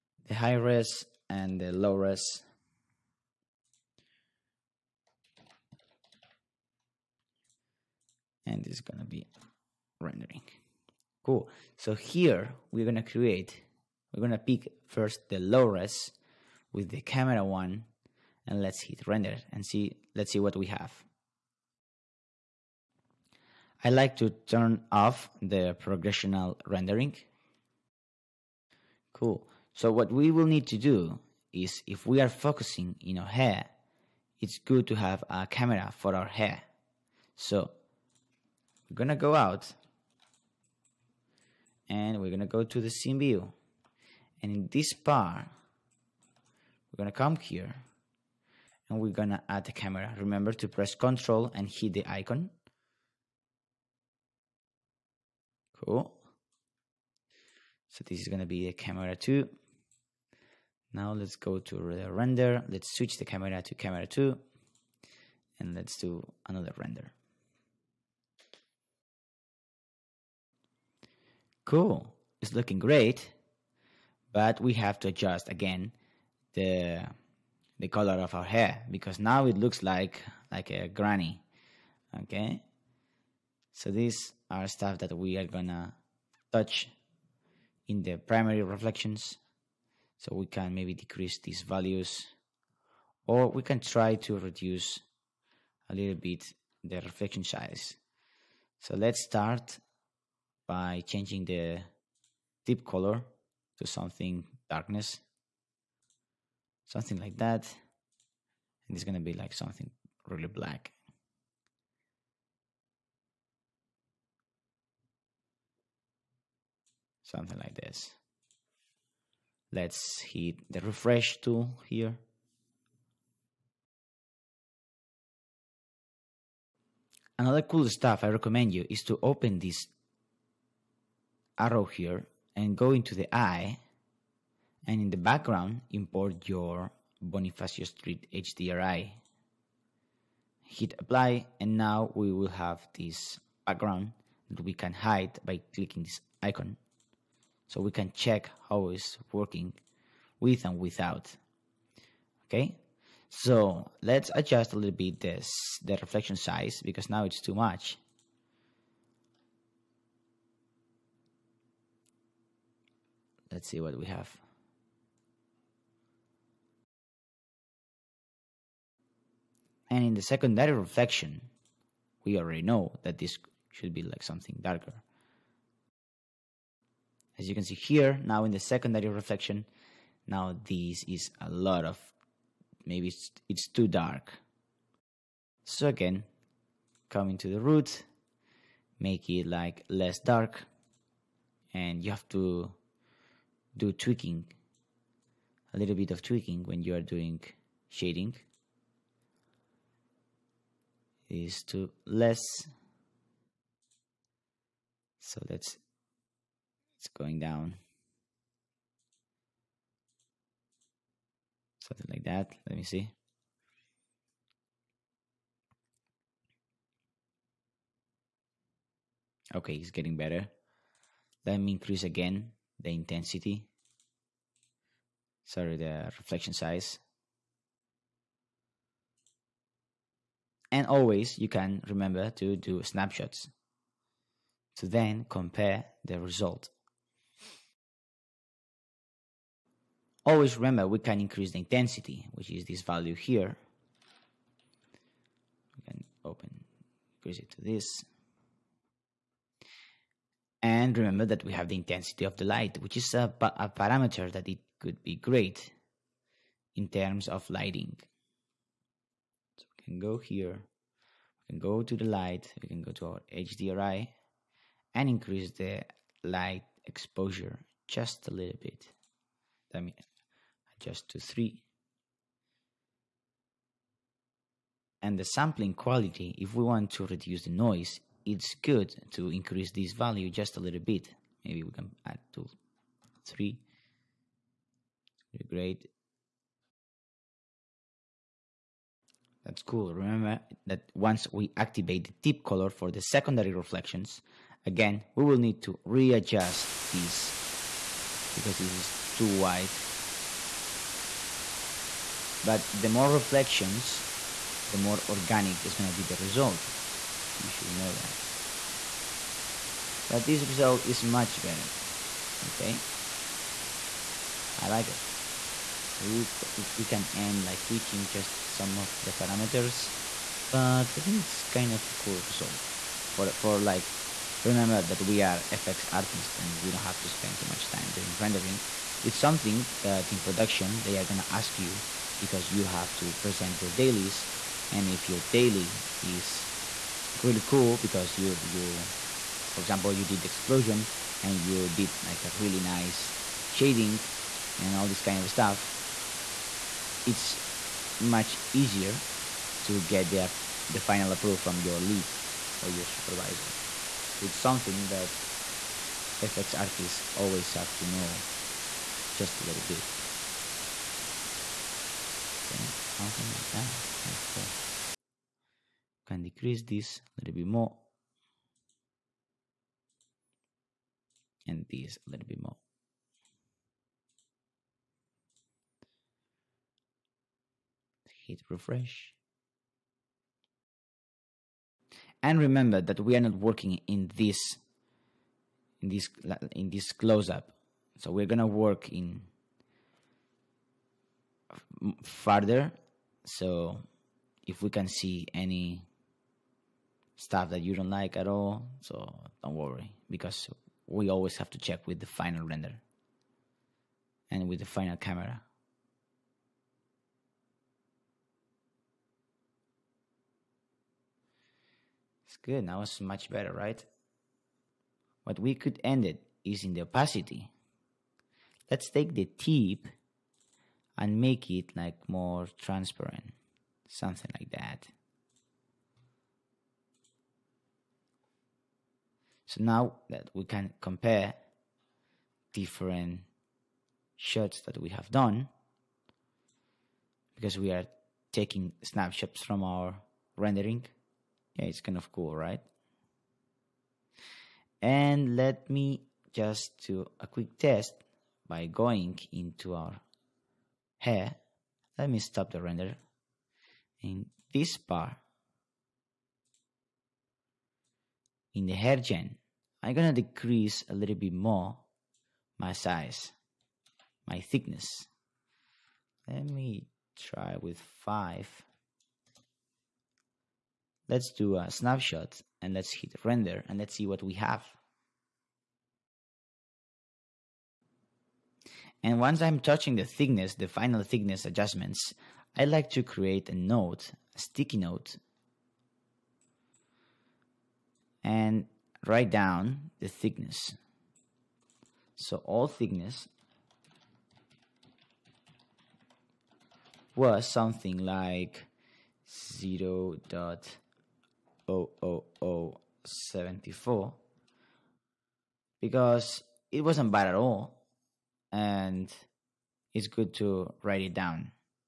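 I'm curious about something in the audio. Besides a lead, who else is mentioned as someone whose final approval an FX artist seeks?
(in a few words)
supervisor.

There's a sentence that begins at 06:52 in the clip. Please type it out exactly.
It's good, now it's much better, right?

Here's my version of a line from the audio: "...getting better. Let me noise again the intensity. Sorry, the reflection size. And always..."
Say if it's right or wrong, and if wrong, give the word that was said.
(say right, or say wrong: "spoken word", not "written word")
wrong: "increase", not "noise".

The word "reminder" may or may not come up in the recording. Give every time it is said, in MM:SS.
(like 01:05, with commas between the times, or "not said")
not said.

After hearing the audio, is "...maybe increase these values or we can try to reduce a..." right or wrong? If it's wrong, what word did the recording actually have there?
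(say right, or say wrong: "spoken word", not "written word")
wrong: "decrease", not "increase".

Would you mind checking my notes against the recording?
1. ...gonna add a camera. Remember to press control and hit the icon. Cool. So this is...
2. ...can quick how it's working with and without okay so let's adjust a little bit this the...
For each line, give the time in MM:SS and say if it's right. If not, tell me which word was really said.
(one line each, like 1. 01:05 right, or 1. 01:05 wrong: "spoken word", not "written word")
1. 00:49 right
2. 02:27 wrong: "check", not "quick".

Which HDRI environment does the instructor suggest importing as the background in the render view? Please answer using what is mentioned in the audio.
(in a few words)
Bonifacio Street.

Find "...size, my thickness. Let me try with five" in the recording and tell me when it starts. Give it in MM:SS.
07:42.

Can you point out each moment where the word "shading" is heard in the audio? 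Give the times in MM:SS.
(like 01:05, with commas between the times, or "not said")
03:17, 05:43.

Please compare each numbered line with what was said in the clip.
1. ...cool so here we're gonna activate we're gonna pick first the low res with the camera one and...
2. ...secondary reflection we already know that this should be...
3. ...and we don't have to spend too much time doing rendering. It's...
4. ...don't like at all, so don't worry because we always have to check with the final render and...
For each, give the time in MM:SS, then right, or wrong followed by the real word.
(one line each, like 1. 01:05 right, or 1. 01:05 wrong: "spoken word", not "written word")
1. 00:11 wrong: "create", not "activate"
2. 02:50 right
3. 05:26 right
4. 06:37 right.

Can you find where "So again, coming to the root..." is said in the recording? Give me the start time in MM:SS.
03:05.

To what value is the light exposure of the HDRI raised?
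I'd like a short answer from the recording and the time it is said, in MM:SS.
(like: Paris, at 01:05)
3, at 04:30.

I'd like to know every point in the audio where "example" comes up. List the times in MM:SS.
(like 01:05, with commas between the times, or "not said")
05:39.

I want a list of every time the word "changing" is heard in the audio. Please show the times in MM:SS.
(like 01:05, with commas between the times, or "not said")
01:41.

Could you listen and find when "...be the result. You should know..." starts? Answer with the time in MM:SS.
05:05.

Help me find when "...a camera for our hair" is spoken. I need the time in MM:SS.
00:35.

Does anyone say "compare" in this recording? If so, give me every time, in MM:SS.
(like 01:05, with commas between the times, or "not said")
03:55, 07:10.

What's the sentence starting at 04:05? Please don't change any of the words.
We can open, increase it to this.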